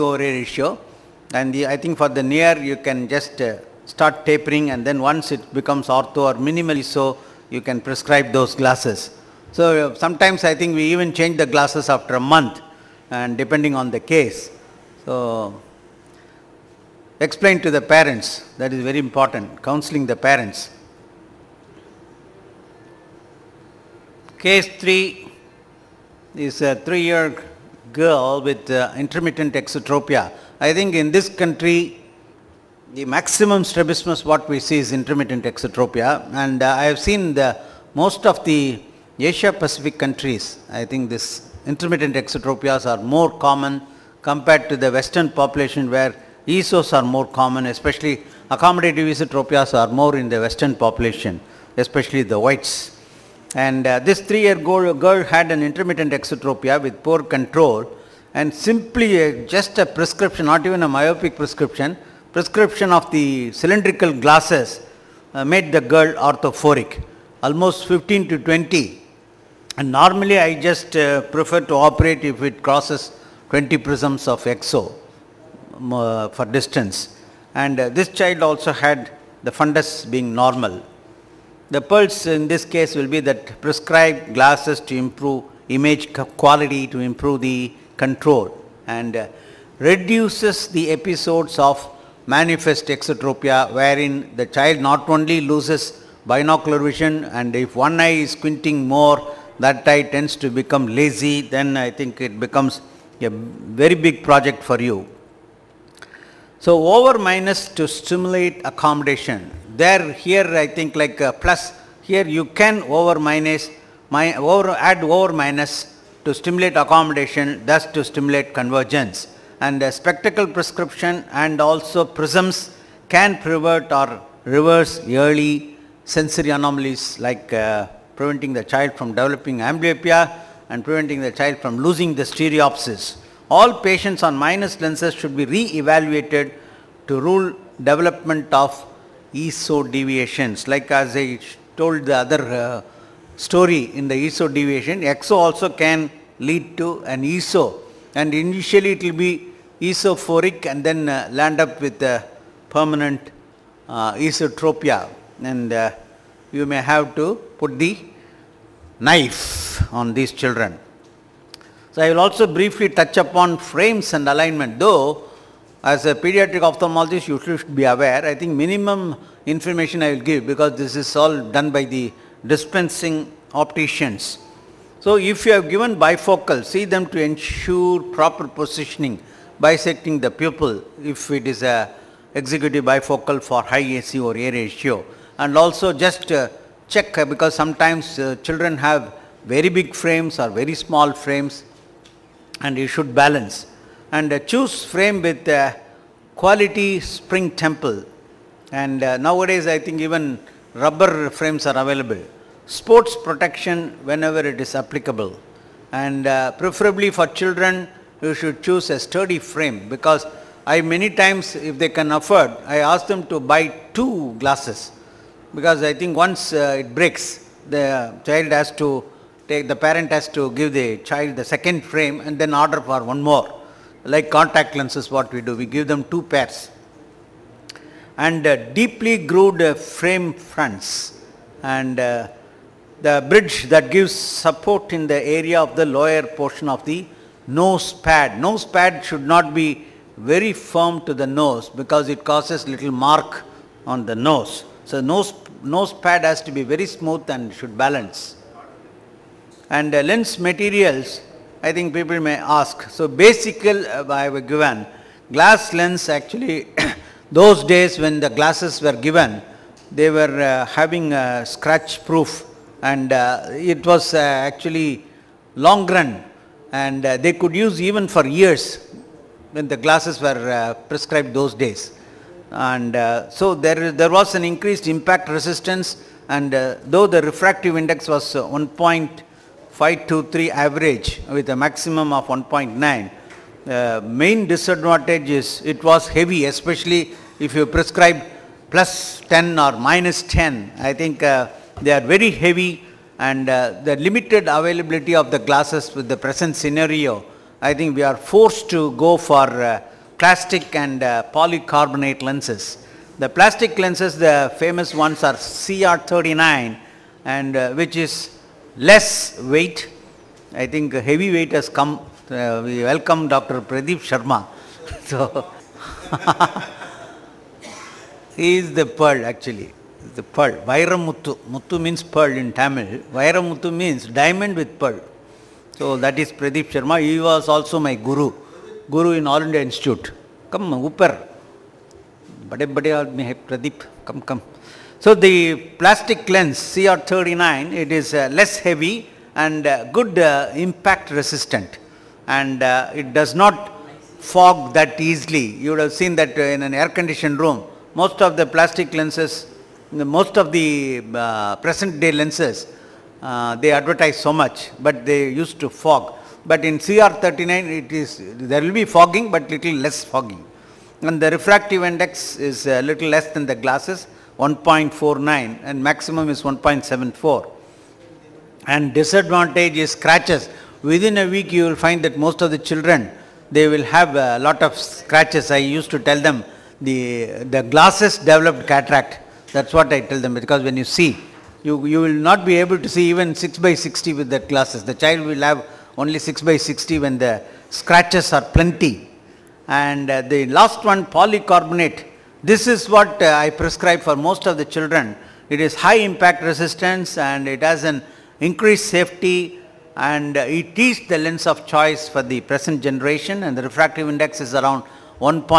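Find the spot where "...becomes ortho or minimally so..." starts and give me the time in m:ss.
0:05.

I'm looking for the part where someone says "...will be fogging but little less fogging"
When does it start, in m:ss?
5:58.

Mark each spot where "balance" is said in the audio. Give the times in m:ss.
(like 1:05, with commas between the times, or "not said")
3:13, 4:07.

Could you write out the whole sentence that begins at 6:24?
The child will have only 6 by 60 when the scratches are plenty.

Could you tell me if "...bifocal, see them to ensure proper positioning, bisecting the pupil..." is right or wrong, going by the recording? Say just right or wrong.
right.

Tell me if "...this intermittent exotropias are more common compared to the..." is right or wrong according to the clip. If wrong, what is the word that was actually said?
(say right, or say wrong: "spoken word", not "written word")
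right.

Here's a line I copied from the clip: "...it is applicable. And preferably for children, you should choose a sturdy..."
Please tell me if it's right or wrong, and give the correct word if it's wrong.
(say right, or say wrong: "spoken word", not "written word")
right.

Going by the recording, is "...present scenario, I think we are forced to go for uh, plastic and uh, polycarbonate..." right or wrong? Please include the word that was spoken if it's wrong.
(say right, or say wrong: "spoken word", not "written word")
right.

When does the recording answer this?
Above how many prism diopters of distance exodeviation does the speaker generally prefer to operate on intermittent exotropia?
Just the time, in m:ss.
1:13.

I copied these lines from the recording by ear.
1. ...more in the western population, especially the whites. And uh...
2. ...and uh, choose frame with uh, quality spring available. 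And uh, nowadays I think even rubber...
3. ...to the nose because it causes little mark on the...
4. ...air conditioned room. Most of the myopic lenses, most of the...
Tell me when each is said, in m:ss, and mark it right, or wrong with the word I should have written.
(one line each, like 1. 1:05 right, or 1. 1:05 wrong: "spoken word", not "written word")
1. 0:49 right
2. 3:14 wrong: "temple", not "available"
3. 4:01 right
4. 5:46 wrong: "plastic", not "myopic".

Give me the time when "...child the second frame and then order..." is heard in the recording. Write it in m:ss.
3:40.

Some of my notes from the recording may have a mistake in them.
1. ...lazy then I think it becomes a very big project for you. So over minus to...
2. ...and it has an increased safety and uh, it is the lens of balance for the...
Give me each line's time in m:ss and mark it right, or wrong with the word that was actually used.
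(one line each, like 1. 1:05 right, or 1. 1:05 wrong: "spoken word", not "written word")
1. 1:40 right
2. 6:37 wrong: "choice", not "balance".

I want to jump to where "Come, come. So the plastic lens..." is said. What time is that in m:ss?
5:34.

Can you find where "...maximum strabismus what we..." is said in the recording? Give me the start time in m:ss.
0:33.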